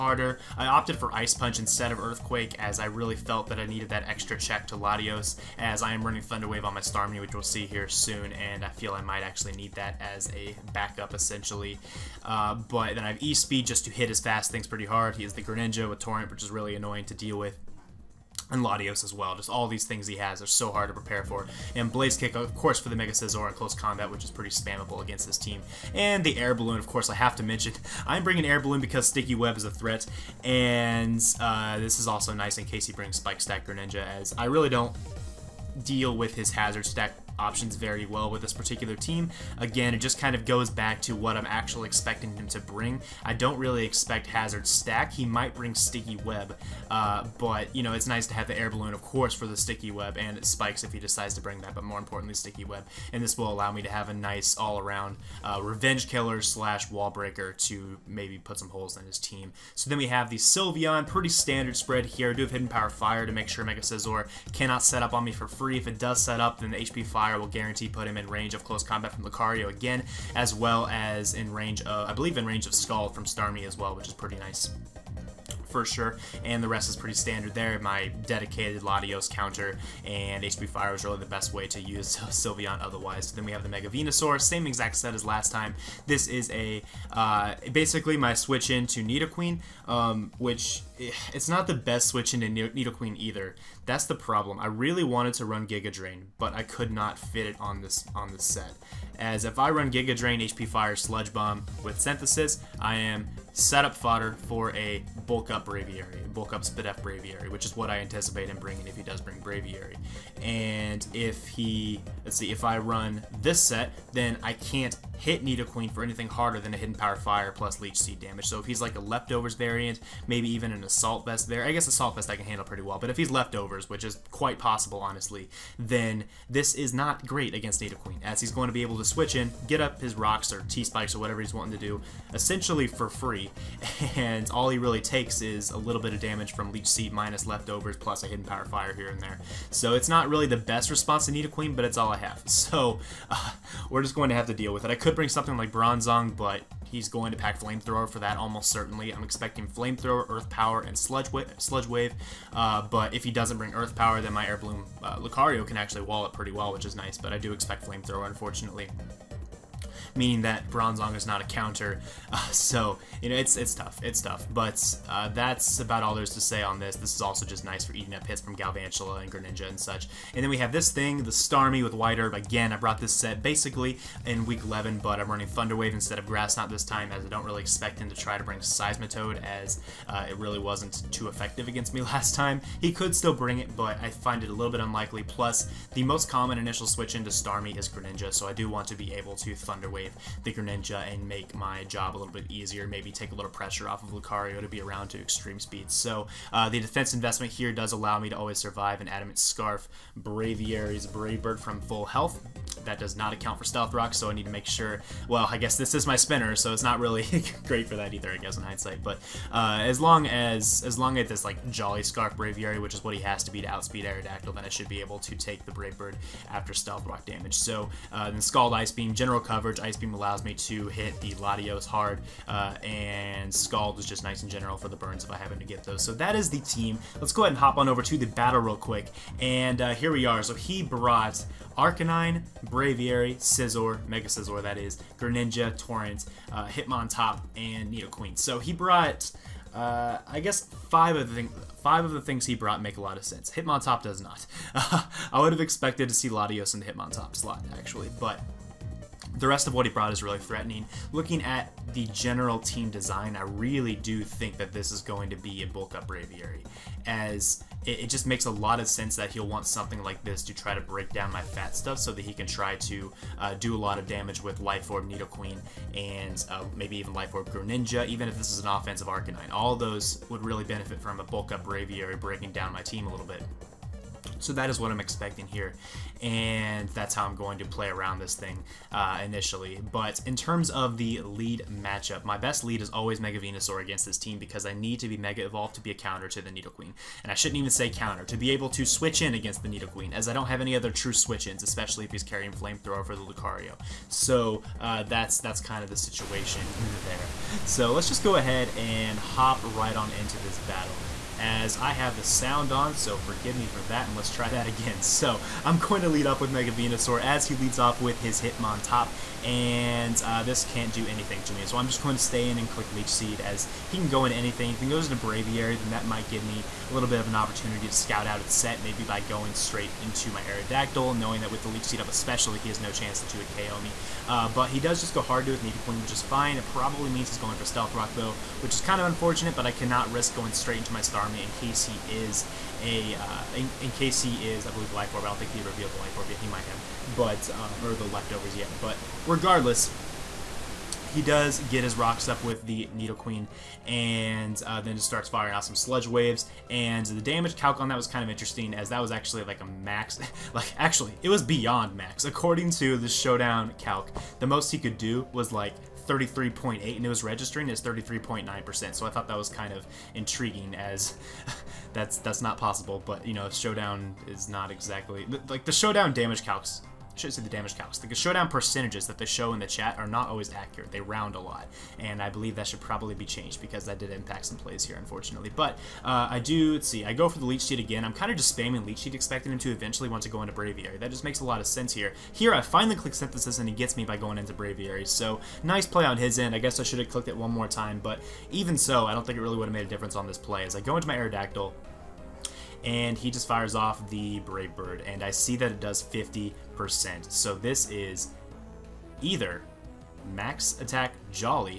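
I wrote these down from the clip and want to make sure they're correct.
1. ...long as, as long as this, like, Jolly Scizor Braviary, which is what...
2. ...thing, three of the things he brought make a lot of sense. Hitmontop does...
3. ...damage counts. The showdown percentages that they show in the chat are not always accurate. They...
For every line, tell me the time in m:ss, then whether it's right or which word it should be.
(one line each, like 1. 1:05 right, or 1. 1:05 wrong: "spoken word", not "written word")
1. 3:29 wrong: "Scarf", not "Scizor"
2. 4:01 wrong: "five", not "three"
3. 6:07 right.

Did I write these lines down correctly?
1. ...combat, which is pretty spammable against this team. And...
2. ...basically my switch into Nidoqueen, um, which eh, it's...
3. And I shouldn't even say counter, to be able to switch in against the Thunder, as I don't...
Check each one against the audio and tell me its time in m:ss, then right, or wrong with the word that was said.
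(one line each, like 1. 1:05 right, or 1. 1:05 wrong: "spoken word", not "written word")
1. 0:23 right
2. 1:27 right
3. 4:47 wrong: "Nidoqueen", not "Thunder".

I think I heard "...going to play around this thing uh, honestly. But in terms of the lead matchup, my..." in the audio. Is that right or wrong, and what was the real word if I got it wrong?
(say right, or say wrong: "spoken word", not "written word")
wrong: "initially", not "honestly".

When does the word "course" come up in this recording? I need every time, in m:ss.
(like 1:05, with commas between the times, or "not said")
0:22, 0:26, 0:49.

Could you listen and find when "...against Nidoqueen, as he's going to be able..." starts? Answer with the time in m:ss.
2:07.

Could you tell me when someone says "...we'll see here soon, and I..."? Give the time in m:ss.
0:07.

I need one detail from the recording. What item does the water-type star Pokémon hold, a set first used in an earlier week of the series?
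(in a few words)
White Herb.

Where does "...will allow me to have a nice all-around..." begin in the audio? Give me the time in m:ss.
0:53.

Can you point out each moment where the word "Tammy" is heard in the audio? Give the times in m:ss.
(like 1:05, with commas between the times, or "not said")
not said.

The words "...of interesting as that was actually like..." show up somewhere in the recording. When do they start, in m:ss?
5:48.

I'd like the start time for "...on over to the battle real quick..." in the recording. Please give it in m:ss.
3:47.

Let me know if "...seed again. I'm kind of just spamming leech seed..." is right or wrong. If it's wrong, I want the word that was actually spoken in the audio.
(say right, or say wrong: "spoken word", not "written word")
right.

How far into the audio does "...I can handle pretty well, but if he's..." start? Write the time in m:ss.
2:02.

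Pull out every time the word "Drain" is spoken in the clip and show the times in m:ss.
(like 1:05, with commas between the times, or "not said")
1:35, 1:40.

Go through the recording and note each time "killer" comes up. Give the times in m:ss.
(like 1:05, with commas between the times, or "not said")
0:56.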